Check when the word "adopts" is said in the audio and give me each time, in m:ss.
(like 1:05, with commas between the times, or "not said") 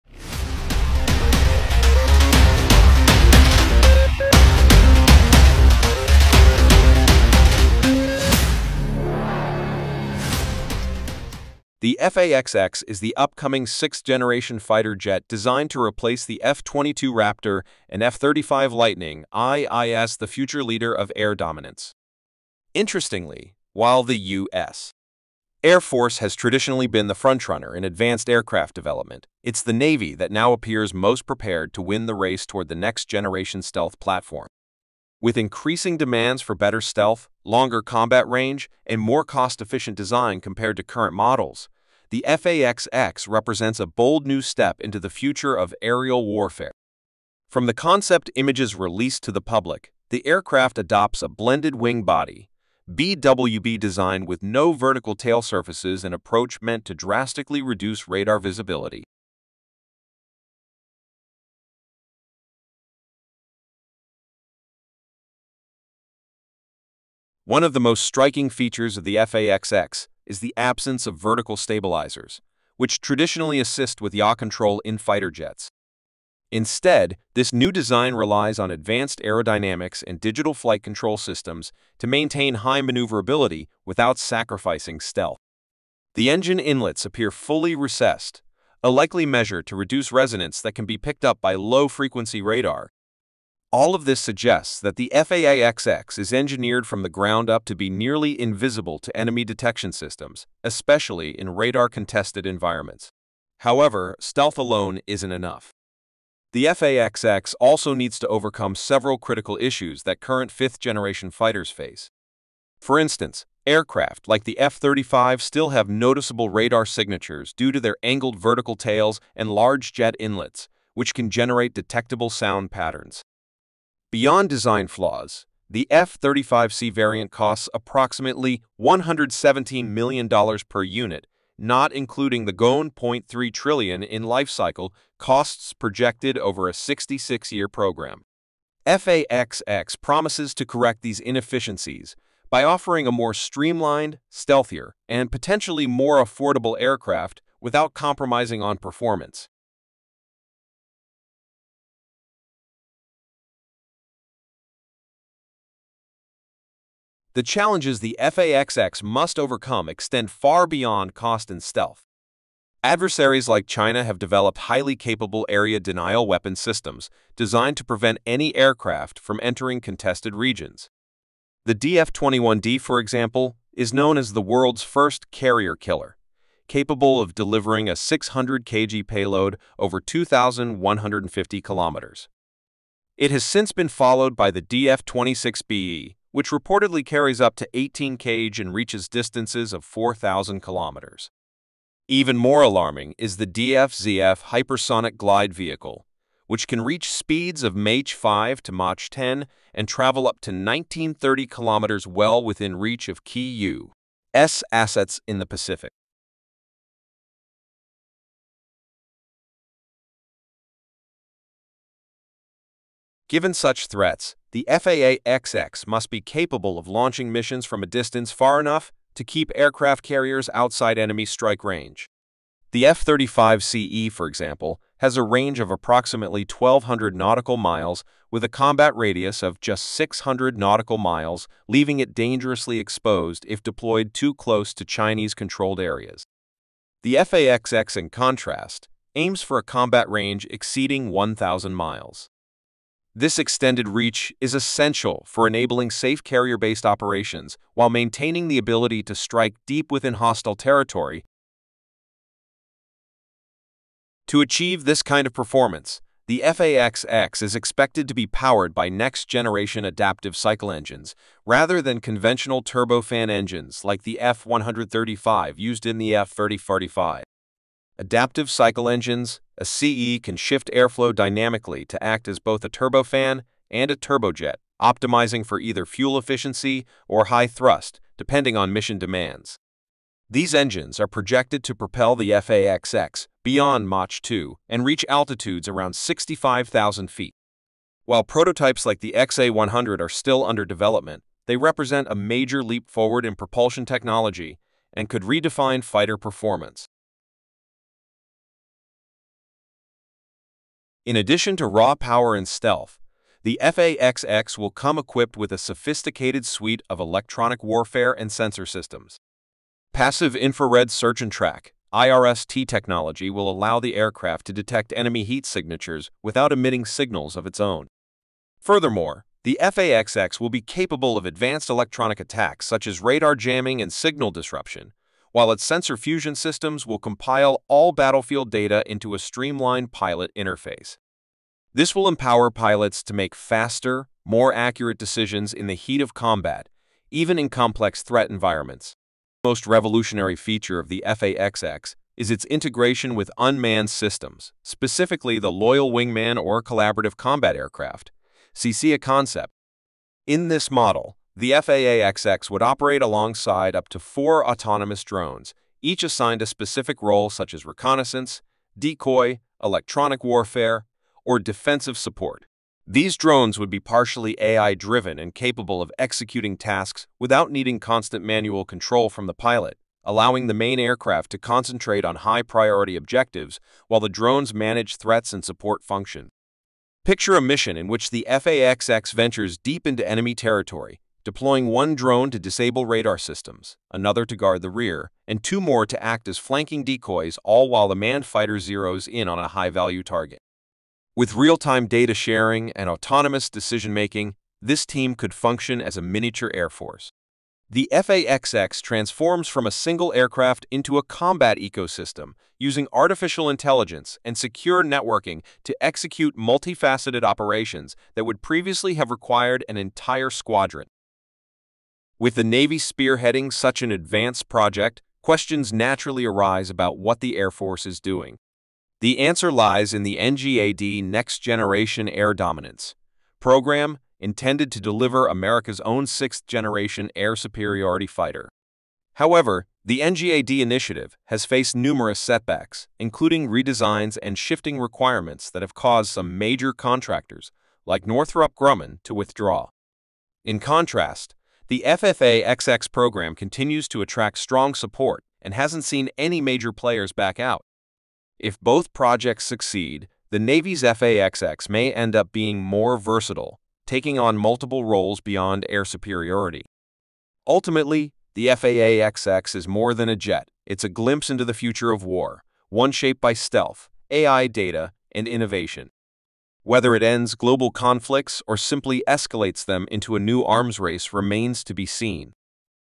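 0:50.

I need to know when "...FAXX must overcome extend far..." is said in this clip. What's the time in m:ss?
2:38.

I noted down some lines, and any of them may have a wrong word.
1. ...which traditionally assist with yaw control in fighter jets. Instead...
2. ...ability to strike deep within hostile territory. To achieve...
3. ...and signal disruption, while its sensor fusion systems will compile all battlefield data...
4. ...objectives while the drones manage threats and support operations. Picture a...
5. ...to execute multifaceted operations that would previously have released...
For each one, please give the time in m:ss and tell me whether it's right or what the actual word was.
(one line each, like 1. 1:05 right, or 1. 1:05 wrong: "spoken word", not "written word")
1. 1:12 right
2. 4:08 right
3. 5:23 right
4. 6:12 wrong: "functions", not "operations"
5. 6:45 wrong: "required", not "released".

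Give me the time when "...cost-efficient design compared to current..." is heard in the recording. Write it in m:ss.
0:39.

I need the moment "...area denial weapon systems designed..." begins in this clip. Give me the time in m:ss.
2:45.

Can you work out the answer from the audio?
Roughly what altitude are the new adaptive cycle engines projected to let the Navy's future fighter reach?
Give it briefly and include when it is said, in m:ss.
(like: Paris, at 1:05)
65,000 feet, at 4:45.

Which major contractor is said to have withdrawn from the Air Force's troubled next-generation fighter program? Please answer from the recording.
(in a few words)
Northrop Grumman.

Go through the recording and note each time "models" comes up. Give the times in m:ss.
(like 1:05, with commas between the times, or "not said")
0:41, 5:50.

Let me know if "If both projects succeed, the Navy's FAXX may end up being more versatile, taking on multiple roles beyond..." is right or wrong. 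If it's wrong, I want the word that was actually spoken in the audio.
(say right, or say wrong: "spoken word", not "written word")
right.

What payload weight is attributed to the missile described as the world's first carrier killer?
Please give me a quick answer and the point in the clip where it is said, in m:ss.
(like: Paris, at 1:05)
600 kg, at 2:57.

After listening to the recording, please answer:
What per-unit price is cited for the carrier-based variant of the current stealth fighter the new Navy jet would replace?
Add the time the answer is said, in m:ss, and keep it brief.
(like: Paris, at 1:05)
$117 million, at 2:08.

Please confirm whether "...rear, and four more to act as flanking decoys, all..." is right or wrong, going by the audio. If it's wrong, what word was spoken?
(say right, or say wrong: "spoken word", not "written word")
wrong: "two", not "four".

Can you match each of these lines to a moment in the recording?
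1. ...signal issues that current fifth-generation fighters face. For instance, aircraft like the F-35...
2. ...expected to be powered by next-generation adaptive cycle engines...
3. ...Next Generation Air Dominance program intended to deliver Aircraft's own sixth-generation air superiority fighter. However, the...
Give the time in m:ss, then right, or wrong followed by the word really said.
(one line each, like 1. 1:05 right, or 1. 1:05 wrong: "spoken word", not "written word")
1. 1:49 wrong: "critical", not "signal"
2. 4:17 right
3. 7:01 wrong: "America", not "Aircraft".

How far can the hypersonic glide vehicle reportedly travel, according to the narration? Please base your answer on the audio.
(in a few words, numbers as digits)
1930 kilometers.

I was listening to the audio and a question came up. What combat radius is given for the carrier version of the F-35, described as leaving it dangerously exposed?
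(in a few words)
600 nautical miles.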